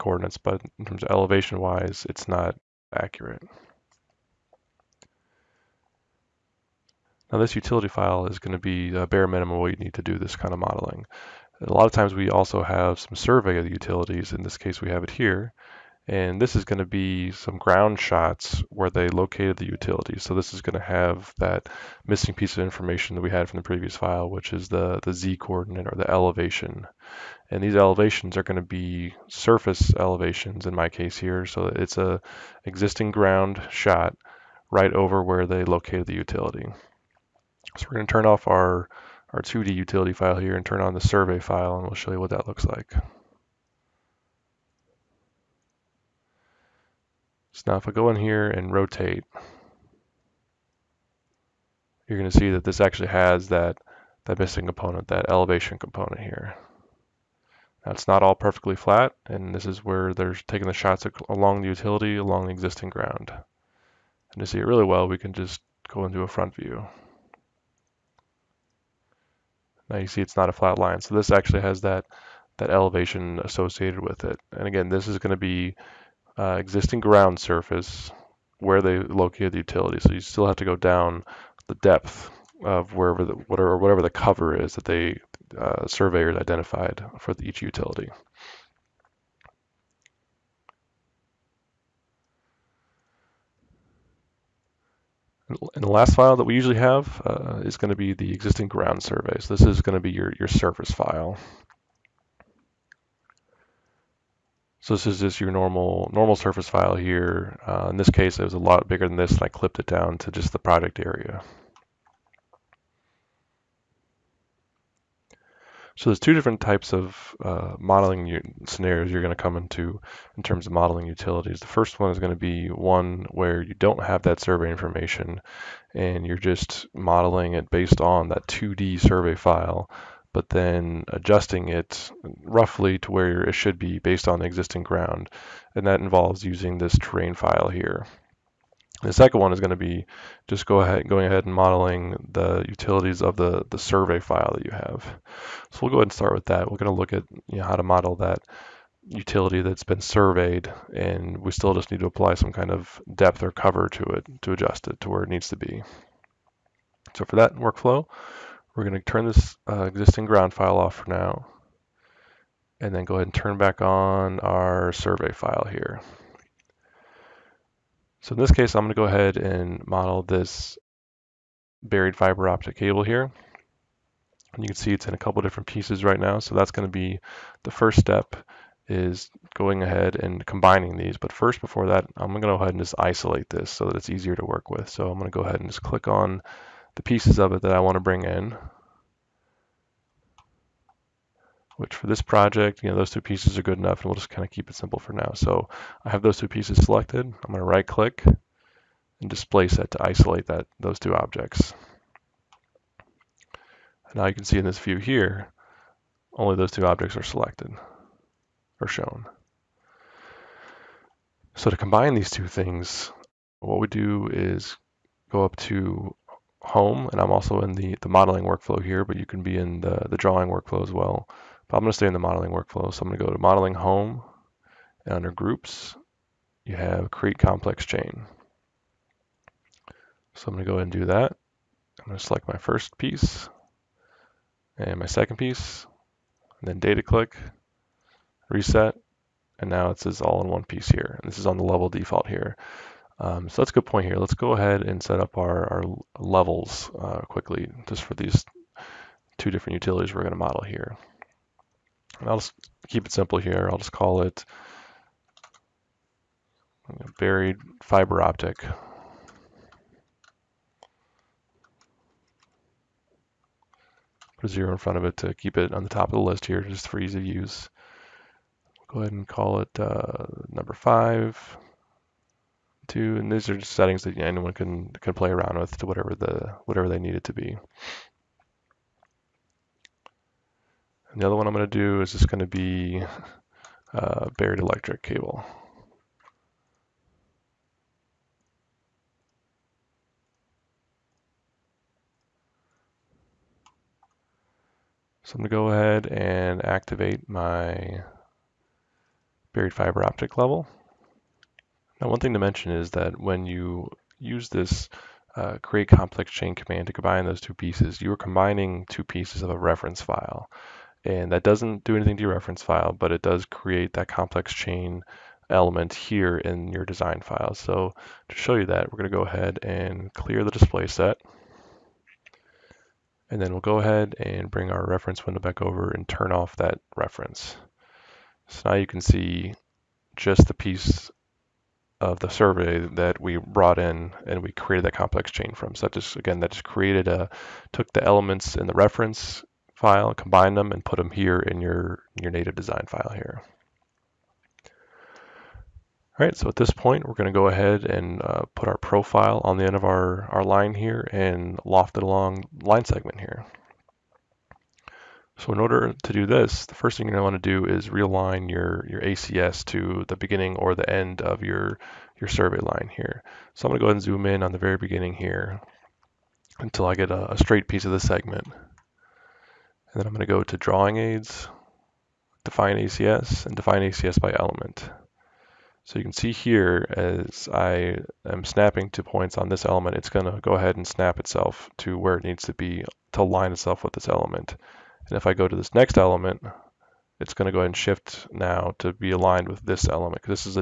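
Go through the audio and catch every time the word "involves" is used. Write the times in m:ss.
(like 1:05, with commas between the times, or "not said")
2:16.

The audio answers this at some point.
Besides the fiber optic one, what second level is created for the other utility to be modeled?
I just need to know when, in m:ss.
4:44.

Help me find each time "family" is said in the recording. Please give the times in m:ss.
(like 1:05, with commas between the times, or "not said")
not said.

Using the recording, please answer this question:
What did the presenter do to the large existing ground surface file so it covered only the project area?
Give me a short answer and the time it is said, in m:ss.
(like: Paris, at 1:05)
clipped it down, at 1:49.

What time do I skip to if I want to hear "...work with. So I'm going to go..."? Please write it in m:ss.
3:04.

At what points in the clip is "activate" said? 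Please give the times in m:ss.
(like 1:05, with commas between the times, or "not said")
4:56.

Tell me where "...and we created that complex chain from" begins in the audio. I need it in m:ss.
5:34.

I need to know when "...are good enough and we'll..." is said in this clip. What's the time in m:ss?
3:13.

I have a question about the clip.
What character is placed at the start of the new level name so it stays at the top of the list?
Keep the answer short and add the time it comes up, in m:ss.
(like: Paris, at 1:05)
0, at 4:24.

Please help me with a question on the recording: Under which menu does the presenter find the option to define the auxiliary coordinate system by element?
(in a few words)
Drawing Aids.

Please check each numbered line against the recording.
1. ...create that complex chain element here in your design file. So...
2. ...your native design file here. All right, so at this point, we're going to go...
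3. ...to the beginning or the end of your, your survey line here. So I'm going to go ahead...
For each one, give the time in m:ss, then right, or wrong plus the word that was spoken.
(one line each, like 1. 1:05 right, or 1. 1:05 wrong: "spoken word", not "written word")
1. 5:13 right
2. 5:42 right
3. 5:59 right.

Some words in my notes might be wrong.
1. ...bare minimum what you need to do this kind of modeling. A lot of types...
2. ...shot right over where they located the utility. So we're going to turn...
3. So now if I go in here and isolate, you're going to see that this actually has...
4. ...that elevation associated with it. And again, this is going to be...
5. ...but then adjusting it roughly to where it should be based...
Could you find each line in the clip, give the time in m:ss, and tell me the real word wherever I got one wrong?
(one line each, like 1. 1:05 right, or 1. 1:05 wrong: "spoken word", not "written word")
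1. 0:09 wrong: "times", not "types"
2. 0:33 right
3. 0:47 wrong: "rotate", not "isolate"
4. 1:12 right
5. 2:10 right.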